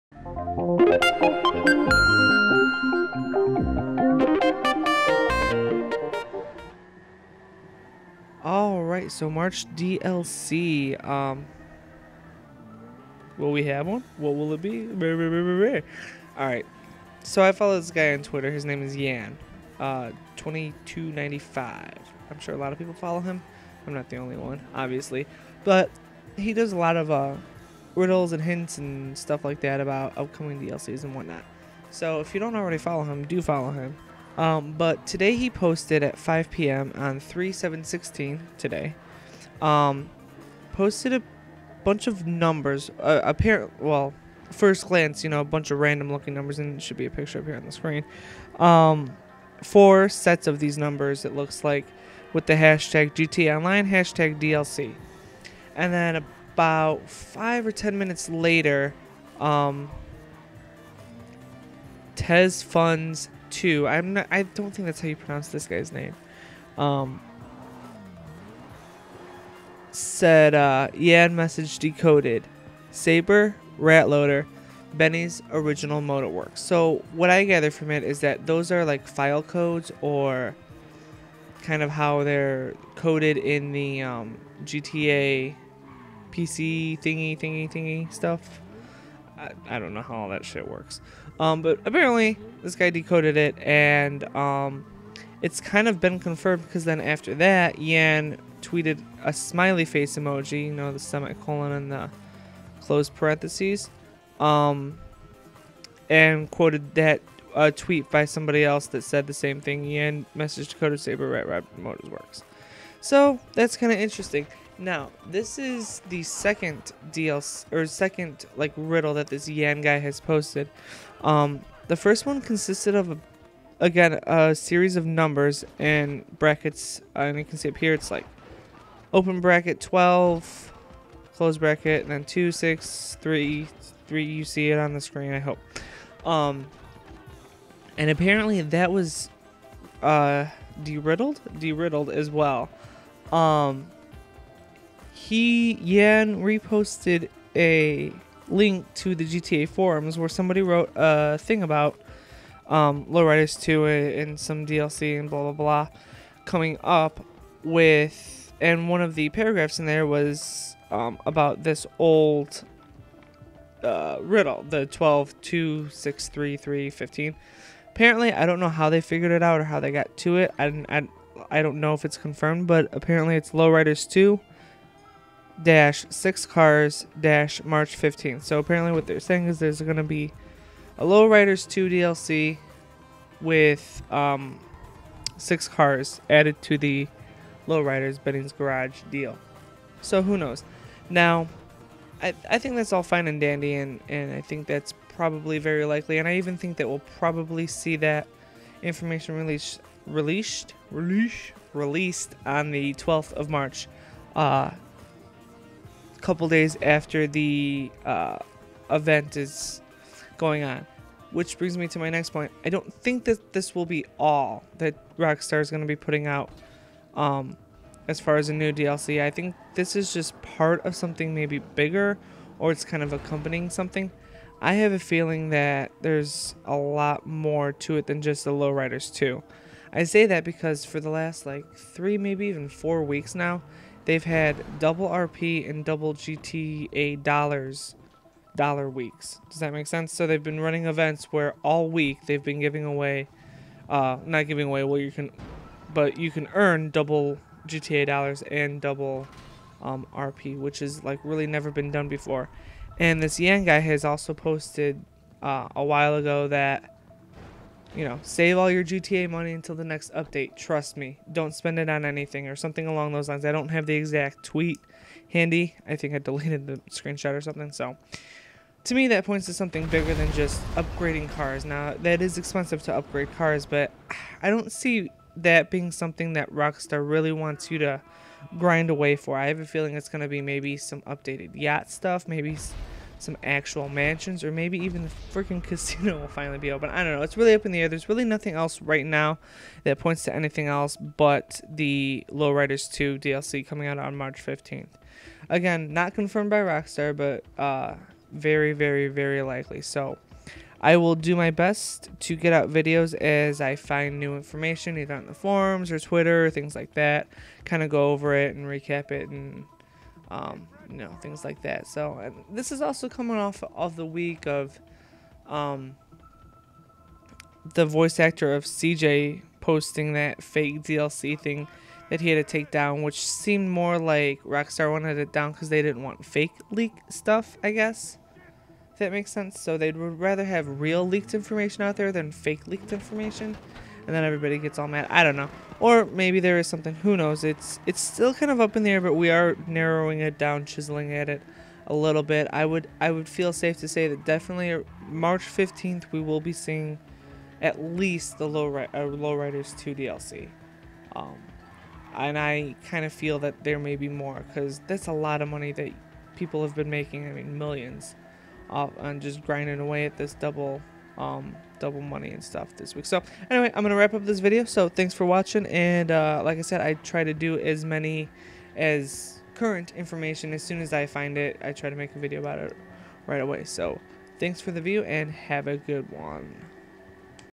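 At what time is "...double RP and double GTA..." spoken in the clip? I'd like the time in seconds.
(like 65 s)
234 s.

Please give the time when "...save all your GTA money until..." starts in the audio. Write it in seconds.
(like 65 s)
258 s.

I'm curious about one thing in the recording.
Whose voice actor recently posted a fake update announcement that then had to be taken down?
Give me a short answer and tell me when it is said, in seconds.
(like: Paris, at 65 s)
CJ, at 318 s.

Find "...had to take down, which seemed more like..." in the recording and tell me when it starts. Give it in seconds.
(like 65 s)
322 s.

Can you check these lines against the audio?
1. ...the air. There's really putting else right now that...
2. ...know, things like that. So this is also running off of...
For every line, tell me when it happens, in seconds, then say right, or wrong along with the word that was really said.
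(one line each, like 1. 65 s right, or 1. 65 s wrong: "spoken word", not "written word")
1. 287 s wrong: "nothing", not "putting"
2. 310 s wrong: "coming", not "running".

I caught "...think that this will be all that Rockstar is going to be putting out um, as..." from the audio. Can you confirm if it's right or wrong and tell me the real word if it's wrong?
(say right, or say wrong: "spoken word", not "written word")
right.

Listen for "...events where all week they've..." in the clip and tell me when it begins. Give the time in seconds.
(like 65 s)
240 s.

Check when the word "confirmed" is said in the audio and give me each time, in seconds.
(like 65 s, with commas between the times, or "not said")
96 s, 172 s, 296 s.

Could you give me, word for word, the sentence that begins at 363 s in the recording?
So anyway, I'm gonna wrap up this video.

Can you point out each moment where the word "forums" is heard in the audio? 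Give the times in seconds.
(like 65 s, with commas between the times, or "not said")
149 s, 305 s.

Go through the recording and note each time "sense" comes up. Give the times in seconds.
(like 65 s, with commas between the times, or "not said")
239 s, 329 s.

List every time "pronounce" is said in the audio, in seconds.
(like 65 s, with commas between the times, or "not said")
65 s.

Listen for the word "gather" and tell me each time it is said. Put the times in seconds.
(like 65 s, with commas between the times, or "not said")
77 s.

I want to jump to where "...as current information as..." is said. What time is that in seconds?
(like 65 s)
368 s.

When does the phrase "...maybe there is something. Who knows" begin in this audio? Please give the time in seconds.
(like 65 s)
336 s.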